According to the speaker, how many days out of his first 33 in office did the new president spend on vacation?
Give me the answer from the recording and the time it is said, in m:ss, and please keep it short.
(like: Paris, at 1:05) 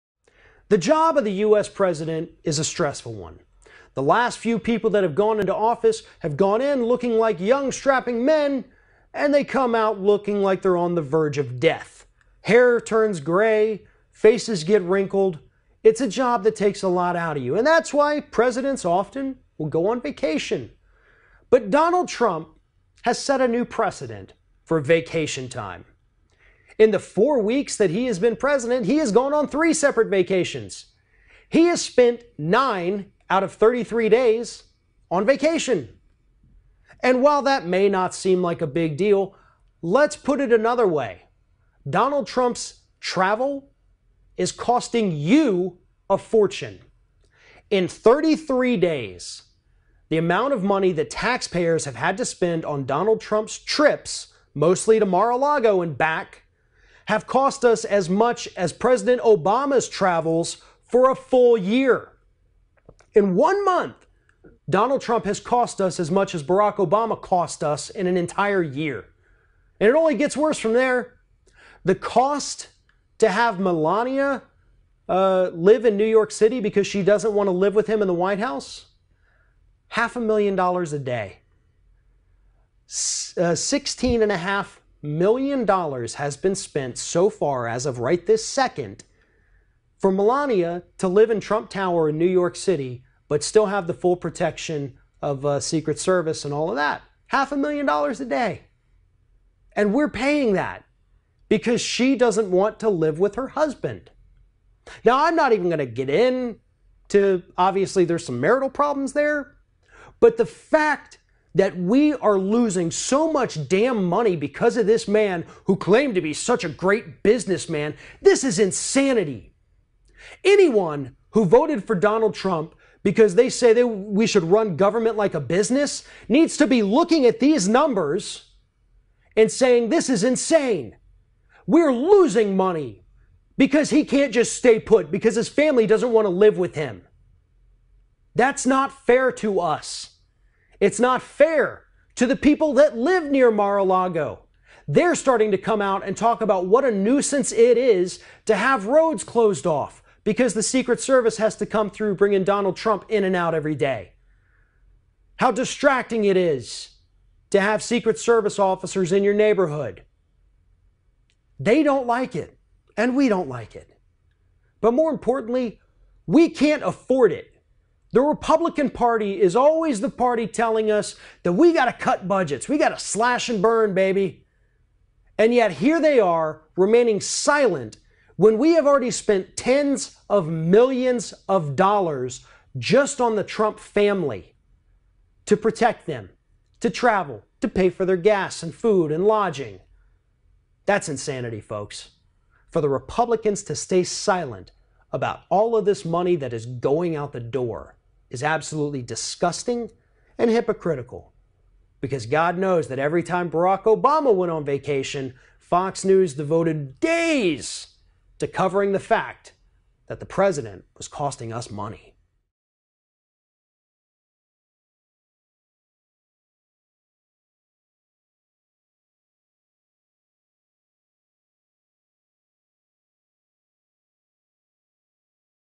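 9, at 0:32.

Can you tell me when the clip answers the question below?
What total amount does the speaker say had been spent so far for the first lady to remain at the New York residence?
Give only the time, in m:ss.
1:23.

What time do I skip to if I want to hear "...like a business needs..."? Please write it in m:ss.
2:05.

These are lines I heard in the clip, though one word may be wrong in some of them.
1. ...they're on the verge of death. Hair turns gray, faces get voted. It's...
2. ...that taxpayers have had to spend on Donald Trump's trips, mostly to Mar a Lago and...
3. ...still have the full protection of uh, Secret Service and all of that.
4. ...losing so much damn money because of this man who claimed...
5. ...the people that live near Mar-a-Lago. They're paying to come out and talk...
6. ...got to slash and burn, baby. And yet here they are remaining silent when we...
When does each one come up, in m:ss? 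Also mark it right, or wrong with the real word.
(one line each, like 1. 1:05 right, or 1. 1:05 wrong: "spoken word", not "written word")
1. 0:10 wrong: "wrinkled", not "voted"
2. 0:50 right
3. 1:33 right
4. 1:52 right
5. 2:22 wrong: "starting", not "paying"
6. 2:52 right.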